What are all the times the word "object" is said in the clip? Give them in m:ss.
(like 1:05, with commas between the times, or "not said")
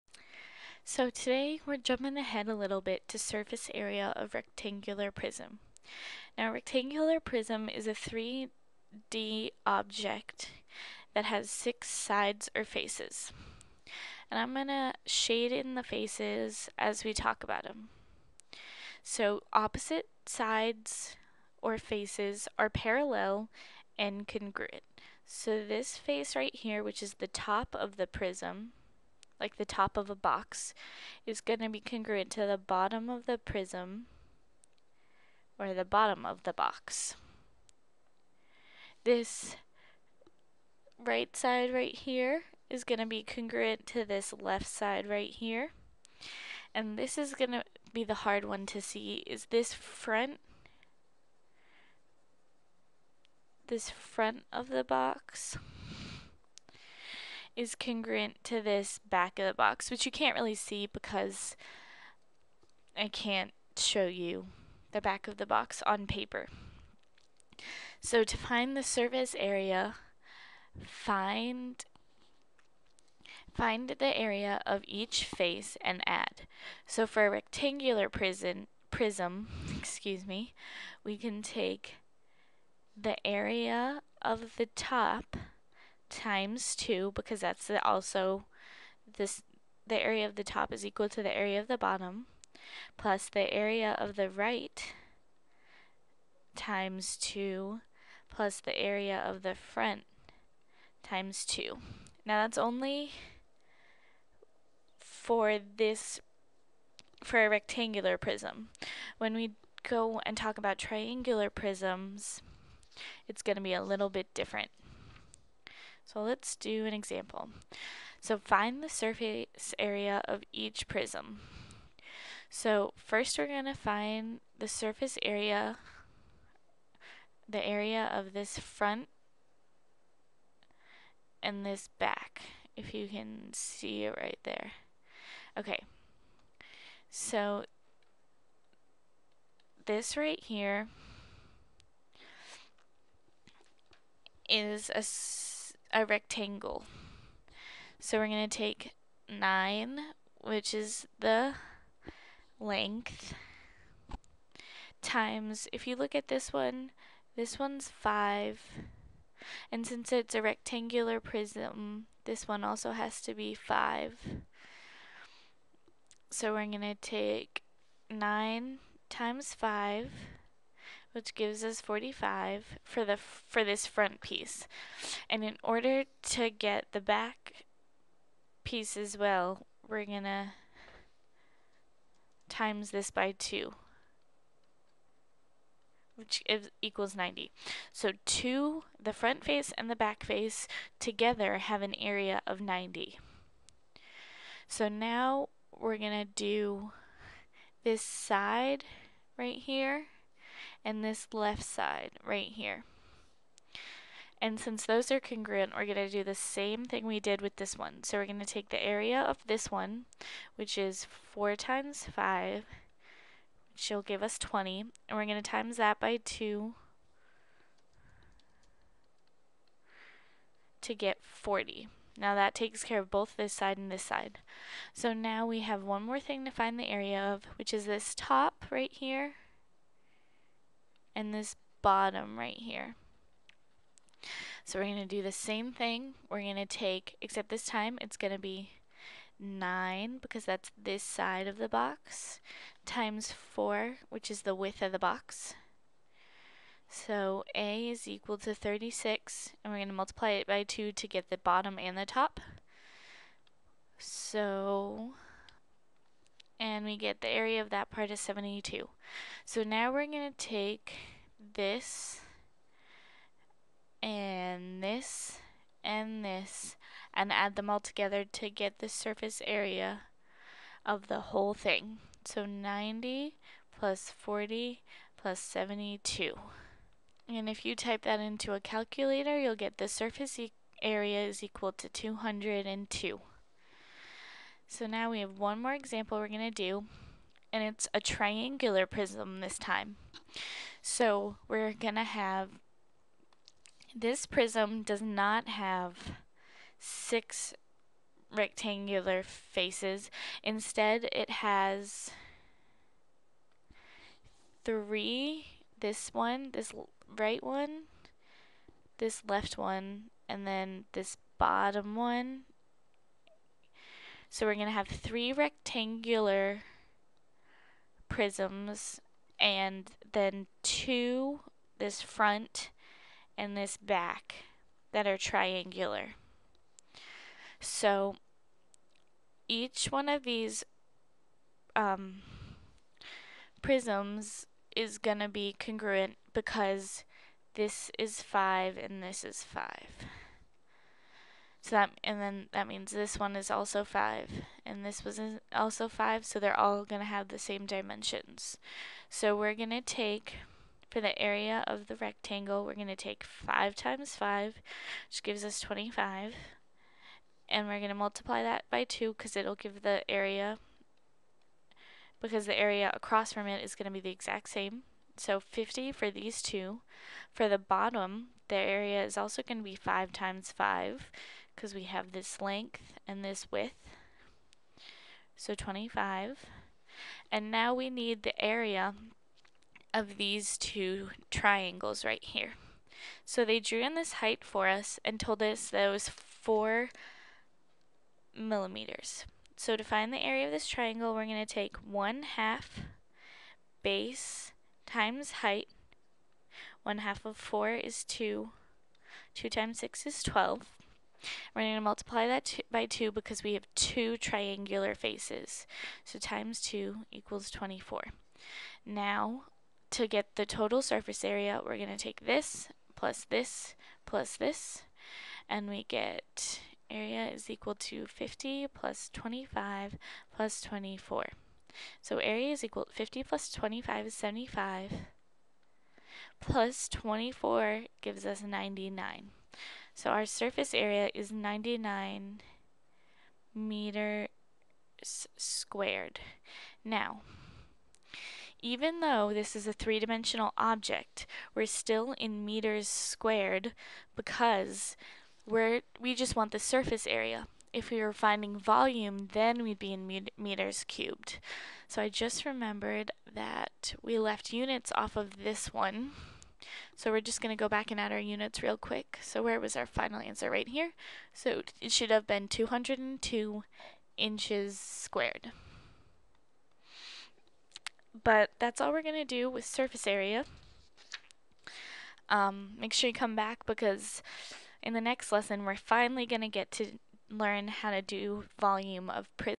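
0:09, 7:20.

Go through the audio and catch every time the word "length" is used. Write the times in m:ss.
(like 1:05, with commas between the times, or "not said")
2:32, 6:12.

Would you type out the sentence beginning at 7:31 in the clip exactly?
So I just remembered that we left units off of this one.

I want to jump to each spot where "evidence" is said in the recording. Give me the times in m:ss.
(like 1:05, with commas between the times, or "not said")
not said.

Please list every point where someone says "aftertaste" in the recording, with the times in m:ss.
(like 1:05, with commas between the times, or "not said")
not said.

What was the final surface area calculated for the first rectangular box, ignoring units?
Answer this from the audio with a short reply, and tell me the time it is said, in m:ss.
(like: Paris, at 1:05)
202, at 4:39.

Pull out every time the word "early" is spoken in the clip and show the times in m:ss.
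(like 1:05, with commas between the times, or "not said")
not said.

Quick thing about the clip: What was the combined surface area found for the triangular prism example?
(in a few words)
99 meters squared.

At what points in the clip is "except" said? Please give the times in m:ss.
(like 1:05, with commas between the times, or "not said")
3:57.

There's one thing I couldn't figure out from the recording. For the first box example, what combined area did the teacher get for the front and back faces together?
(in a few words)
90.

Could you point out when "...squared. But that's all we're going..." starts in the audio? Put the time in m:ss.
7:44.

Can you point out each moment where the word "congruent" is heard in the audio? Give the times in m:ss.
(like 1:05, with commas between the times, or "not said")
0:24, 0:31, 0:43, 0:57, 3:25, 5:35.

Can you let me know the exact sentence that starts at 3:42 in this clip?
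Now that takes care of both this side and this side.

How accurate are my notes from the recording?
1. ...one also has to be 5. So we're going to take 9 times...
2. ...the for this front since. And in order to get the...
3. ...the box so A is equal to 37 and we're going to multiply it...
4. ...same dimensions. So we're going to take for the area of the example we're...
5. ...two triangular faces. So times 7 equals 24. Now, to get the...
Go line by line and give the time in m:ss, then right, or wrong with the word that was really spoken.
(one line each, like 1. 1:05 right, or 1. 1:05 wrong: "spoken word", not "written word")
1. 2:42 right
2. 2:53 wrong: "piece", not "since"
3. 4:04 wrong: "36", not "37"
4. 5:47 wrong: "rectangle", not "example"
5. 6:43 wrong: "2", not "7".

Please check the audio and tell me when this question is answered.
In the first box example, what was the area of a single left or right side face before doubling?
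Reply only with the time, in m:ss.
3:33.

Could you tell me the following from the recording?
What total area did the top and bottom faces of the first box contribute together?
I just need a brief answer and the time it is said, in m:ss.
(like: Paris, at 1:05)
72, at 4:17.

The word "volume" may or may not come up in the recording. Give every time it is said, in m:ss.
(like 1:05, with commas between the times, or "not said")
7:28, 7:58.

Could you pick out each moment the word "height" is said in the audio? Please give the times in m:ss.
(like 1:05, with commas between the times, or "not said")
6:24, 6:35.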